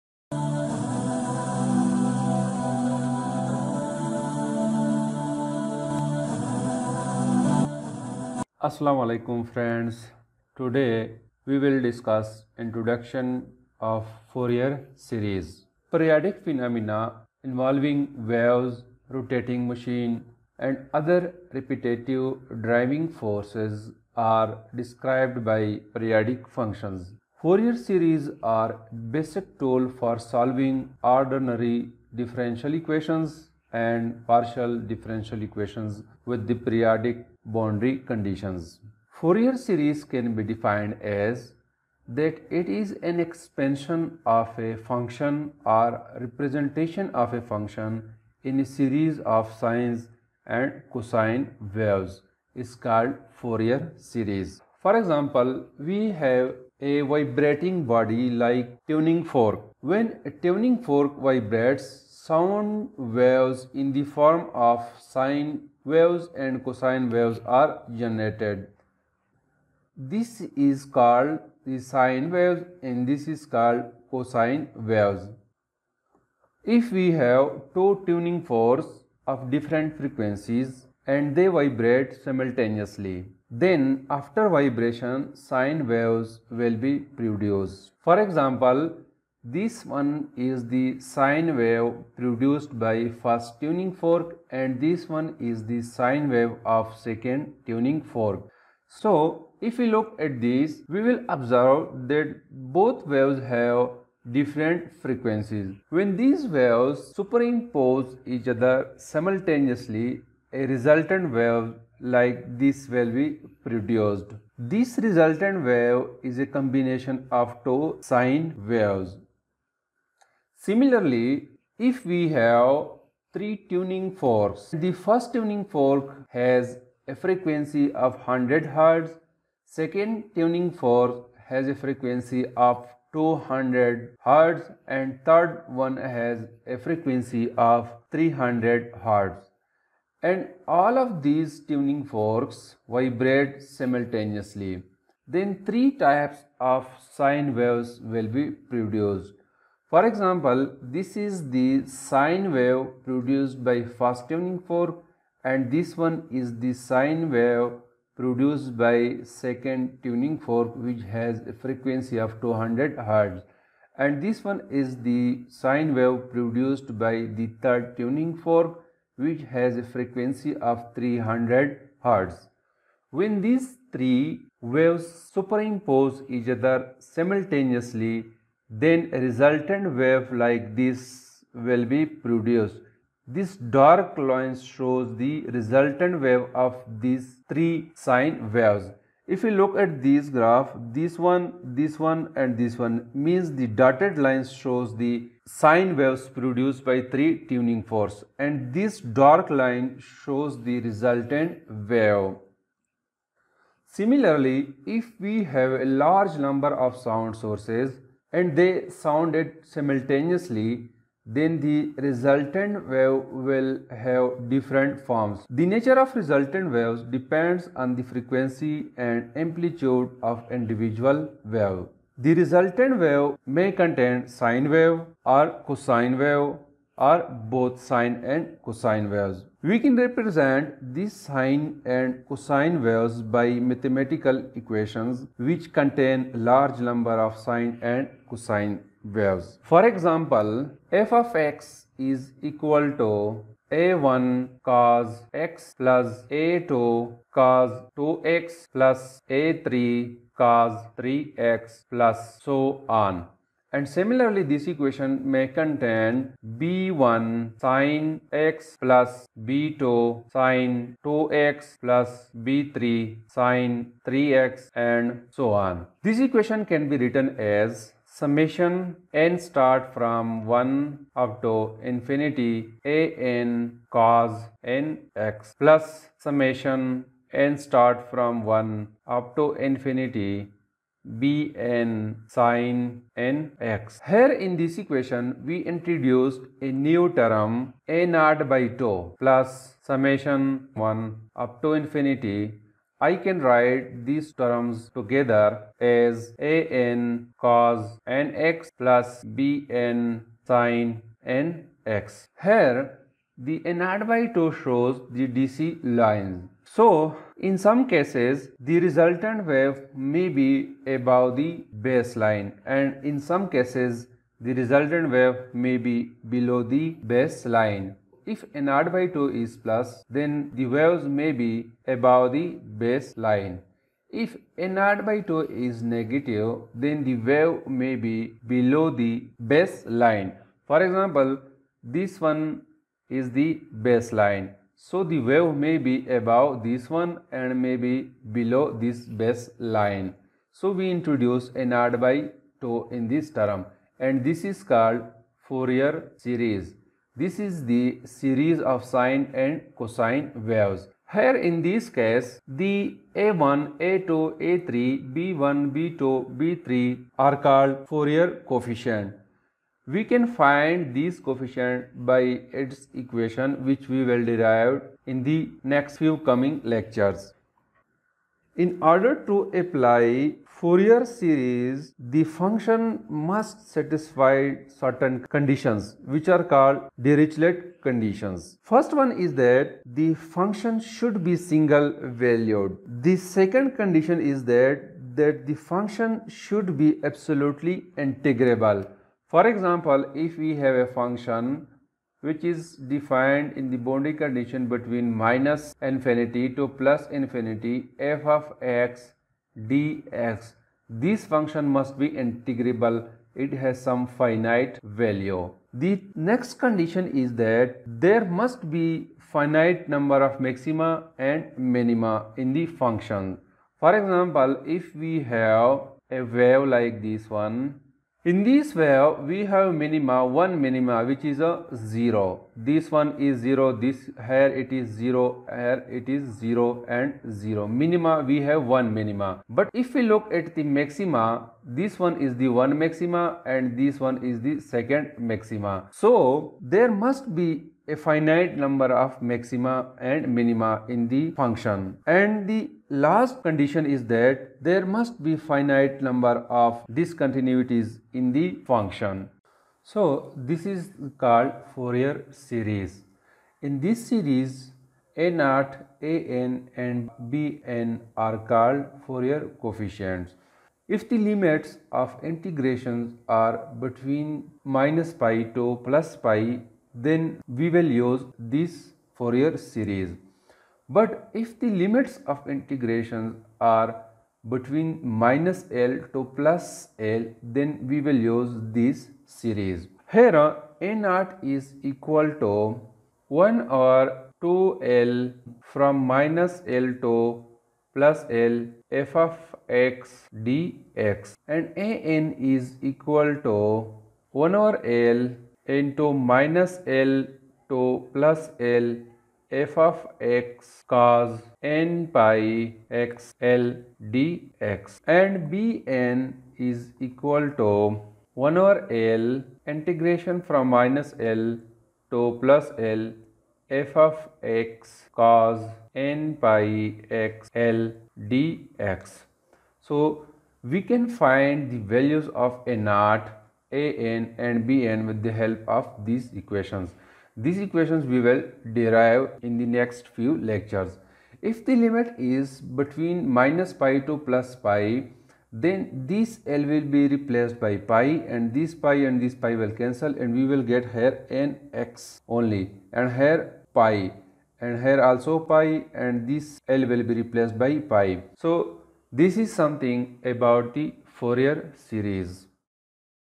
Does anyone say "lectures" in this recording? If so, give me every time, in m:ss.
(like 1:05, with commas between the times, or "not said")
6:06, 8:50.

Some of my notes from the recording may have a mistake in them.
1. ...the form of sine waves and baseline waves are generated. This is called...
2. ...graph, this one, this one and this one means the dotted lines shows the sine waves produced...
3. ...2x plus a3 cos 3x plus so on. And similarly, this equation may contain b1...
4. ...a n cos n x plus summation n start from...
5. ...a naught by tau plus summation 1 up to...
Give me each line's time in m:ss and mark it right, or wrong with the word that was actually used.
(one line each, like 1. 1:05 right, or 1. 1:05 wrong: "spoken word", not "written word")
1. 1:03 wrong: "cosine", not "baseline"
2. 3:10 right
3. 4:07 right
4. 4:32 right
5. 4:47 right.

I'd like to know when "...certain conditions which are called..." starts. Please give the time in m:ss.
6:14.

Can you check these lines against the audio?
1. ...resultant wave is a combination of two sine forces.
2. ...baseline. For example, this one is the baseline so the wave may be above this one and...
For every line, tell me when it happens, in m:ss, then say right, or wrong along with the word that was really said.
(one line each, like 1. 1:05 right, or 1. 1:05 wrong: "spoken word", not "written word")
1. 1:54 wrong: "waves", not "forces"
2. 5:29 right.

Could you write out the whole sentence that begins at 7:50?
But if the limits of integrations are between minus L to plus L, then we will use this series.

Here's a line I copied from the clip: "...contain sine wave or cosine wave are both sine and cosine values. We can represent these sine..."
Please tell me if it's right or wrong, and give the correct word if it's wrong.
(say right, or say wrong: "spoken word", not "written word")
wrong: "waves", not "values".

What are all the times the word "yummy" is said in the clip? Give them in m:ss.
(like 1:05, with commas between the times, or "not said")
not said.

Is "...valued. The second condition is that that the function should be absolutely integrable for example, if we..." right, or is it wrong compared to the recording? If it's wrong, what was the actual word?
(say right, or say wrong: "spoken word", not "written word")
right.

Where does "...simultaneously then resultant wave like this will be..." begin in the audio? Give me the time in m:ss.
2:56.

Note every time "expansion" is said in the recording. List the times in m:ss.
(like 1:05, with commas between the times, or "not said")
0:43.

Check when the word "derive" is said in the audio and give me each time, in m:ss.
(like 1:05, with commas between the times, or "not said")
6:04, 8:48.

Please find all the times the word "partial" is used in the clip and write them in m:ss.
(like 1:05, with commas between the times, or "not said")
0:34.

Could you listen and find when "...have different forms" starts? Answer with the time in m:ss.
3:33.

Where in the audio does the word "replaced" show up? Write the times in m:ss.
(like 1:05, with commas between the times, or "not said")
8:57, 9:07.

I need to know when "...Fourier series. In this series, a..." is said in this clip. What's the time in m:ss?
7:31.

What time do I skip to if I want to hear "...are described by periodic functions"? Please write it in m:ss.
0:24.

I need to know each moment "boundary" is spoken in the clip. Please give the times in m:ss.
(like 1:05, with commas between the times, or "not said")
0:37, 6:33.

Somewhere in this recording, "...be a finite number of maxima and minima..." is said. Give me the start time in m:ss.
7:17.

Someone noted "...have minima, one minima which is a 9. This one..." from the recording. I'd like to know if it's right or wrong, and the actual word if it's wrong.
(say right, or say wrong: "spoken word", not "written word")
wrong: "0", not "9".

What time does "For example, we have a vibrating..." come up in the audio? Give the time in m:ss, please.
0:54.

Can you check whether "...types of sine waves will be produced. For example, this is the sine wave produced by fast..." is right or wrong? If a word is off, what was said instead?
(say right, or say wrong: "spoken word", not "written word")
right.